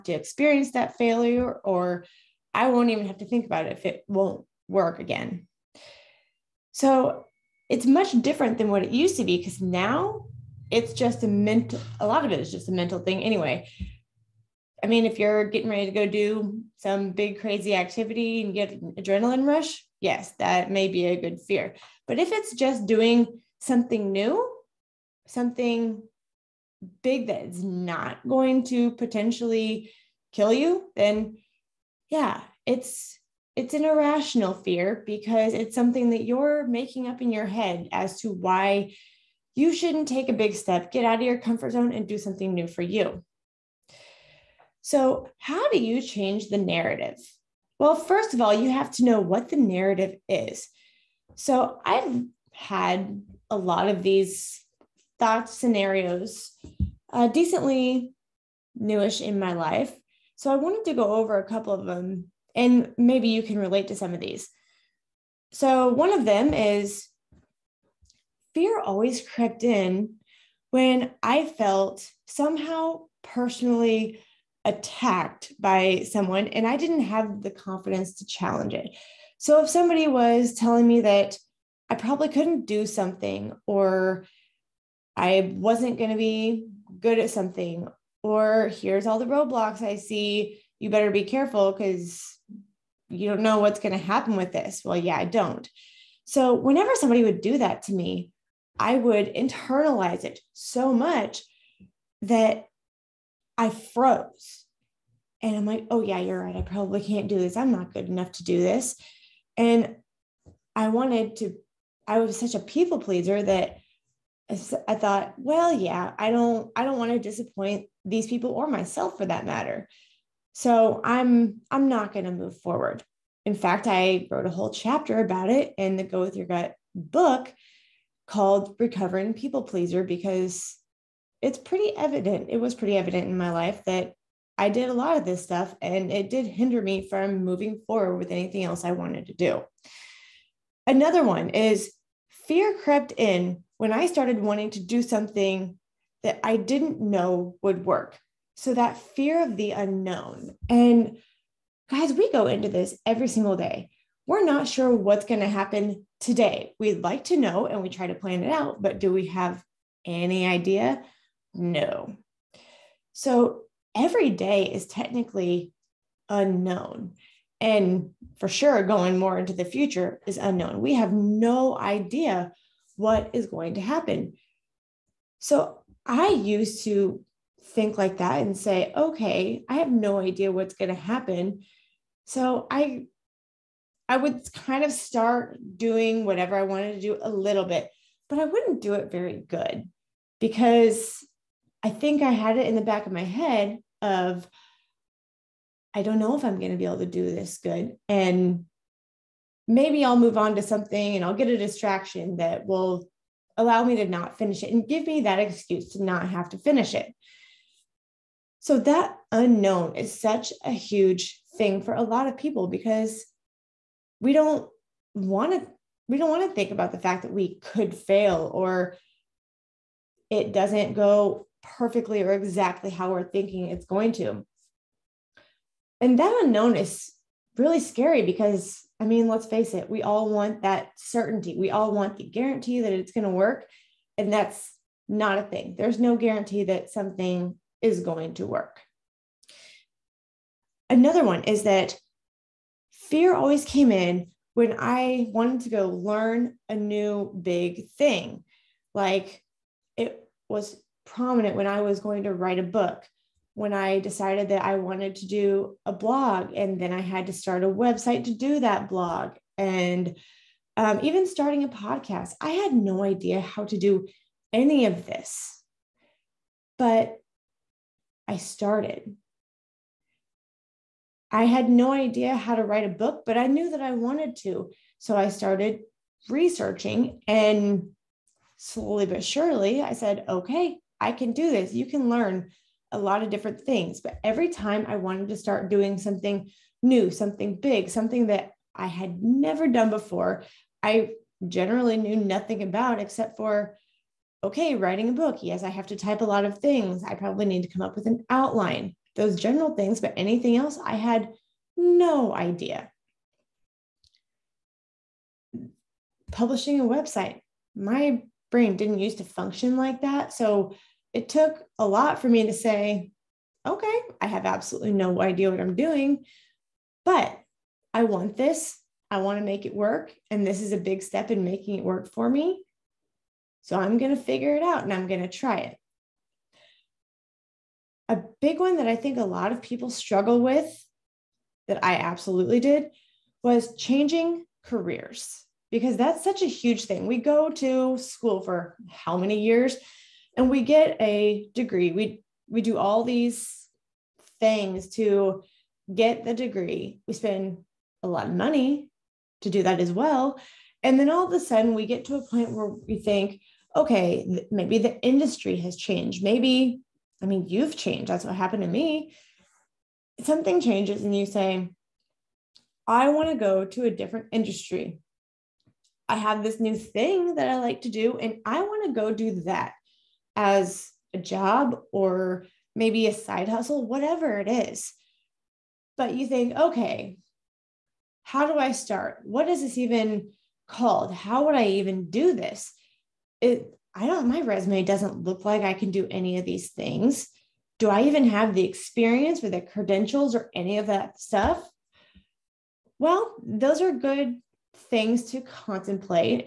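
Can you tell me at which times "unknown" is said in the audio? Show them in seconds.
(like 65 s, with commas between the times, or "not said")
149 s, 166 s, 170 s, 209 s, 226 s.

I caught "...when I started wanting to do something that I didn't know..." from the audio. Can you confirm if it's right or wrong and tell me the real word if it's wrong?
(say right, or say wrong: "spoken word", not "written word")
right.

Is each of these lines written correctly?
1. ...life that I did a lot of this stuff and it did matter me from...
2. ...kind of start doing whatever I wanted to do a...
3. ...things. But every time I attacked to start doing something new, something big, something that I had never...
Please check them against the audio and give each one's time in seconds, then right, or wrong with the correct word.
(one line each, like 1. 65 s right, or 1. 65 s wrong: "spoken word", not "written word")
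1. 133 s wrong: "hinder", not "matter"
2. 184 s right
3. 283 s wrong: "wanted", not "attacked".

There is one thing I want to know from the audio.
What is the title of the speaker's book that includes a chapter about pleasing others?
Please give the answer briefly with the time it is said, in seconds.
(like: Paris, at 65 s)
Go With Your Gut, at 126 s.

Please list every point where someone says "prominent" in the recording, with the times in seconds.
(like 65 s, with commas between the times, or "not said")
251 s.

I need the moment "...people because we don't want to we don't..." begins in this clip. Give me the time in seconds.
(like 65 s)
212 s.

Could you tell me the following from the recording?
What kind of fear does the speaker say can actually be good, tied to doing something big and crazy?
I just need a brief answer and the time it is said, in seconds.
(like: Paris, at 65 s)
adrenaline rush, at 18 s.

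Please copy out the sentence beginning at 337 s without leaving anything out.
We go to school for how many years?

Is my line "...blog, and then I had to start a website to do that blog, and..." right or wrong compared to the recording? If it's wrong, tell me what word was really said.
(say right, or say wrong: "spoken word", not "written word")
right.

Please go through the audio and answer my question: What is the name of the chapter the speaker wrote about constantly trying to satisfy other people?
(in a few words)
Recovering People Pleaser.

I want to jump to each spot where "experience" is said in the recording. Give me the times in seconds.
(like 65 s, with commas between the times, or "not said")
0 s, 388 s.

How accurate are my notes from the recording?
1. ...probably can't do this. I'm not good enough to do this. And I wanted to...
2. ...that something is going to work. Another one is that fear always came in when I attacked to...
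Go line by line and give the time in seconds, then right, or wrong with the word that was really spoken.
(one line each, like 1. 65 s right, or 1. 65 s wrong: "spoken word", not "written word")
1. 106 s right
2. 236 s wrong: "wanted", not "attacked".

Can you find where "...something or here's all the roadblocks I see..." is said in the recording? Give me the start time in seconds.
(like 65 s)
87 s.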